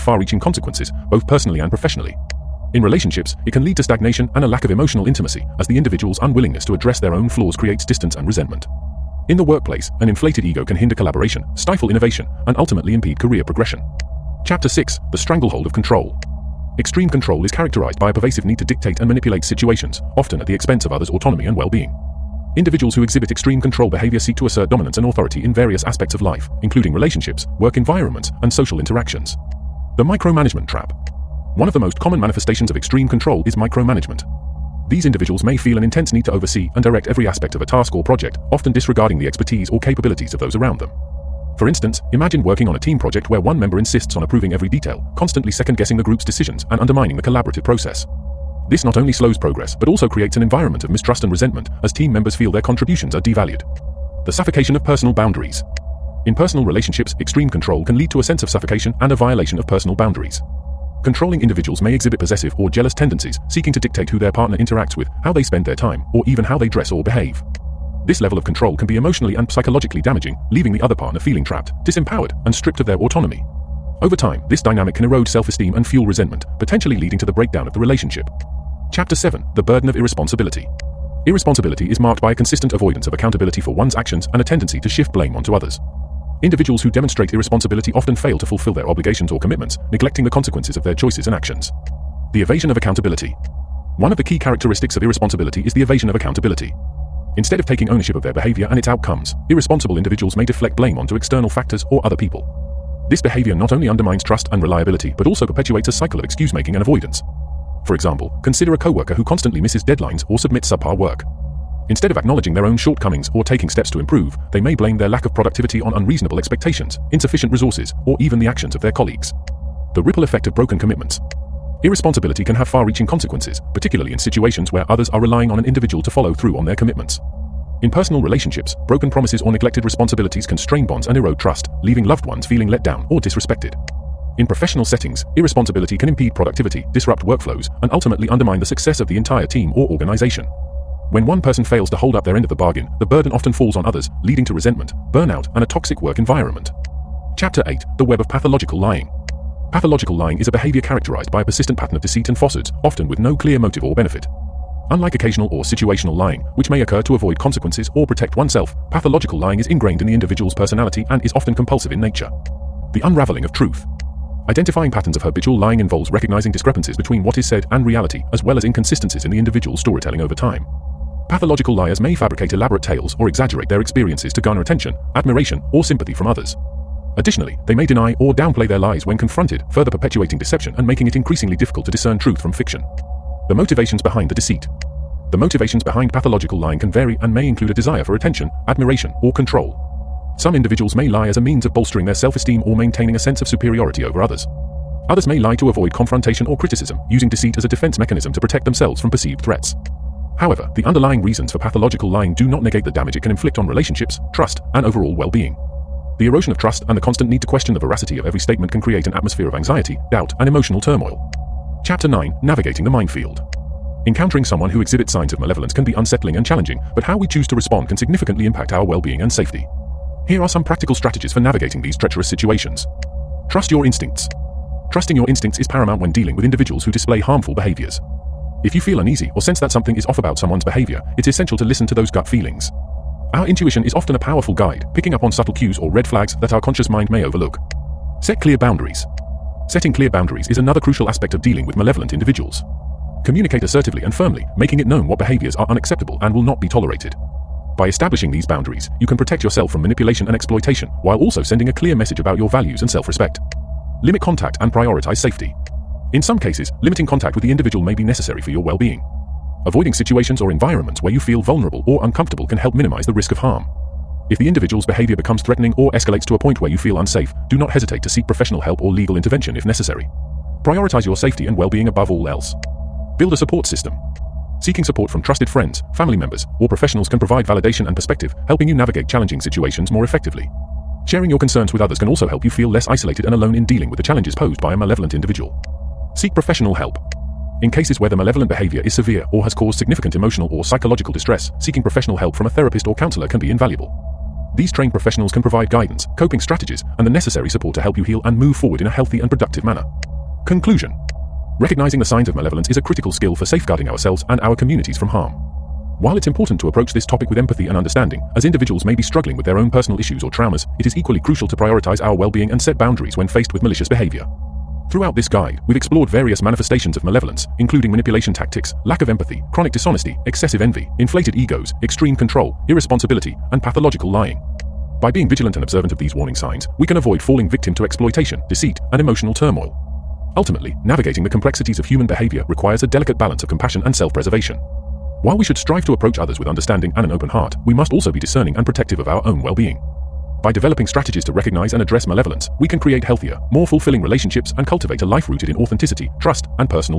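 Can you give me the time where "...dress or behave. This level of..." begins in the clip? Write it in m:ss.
1:06.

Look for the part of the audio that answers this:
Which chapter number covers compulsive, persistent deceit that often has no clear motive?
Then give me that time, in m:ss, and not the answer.
2:27.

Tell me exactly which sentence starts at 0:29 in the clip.
The micromanagement trap one of the most common manifestations of extreme control is micromanagement.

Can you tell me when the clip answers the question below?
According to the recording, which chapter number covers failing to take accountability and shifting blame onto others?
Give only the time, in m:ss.
1:18.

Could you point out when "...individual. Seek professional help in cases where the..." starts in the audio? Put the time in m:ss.
4:45.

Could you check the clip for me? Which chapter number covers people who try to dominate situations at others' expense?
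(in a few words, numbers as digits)
6.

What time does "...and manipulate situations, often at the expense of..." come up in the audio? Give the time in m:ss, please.
0:18.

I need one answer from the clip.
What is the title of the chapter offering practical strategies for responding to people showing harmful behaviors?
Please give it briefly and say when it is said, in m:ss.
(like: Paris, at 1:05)
Navigating the Minefield, at 3:32.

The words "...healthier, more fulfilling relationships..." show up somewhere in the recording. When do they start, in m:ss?
5:43.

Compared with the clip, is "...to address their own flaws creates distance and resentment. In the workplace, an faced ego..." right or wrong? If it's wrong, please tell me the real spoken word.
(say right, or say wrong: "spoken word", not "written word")
wrong: "inflated", not "faced".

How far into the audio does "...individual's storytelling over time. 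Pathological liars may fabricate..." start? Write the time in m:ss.
2:49.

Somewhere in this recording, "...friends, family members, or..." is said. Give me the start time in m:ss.
4:35.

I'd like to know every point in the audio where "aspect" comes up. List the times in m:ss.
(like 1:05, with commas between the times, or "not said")
0:25, 0:37, 4:01.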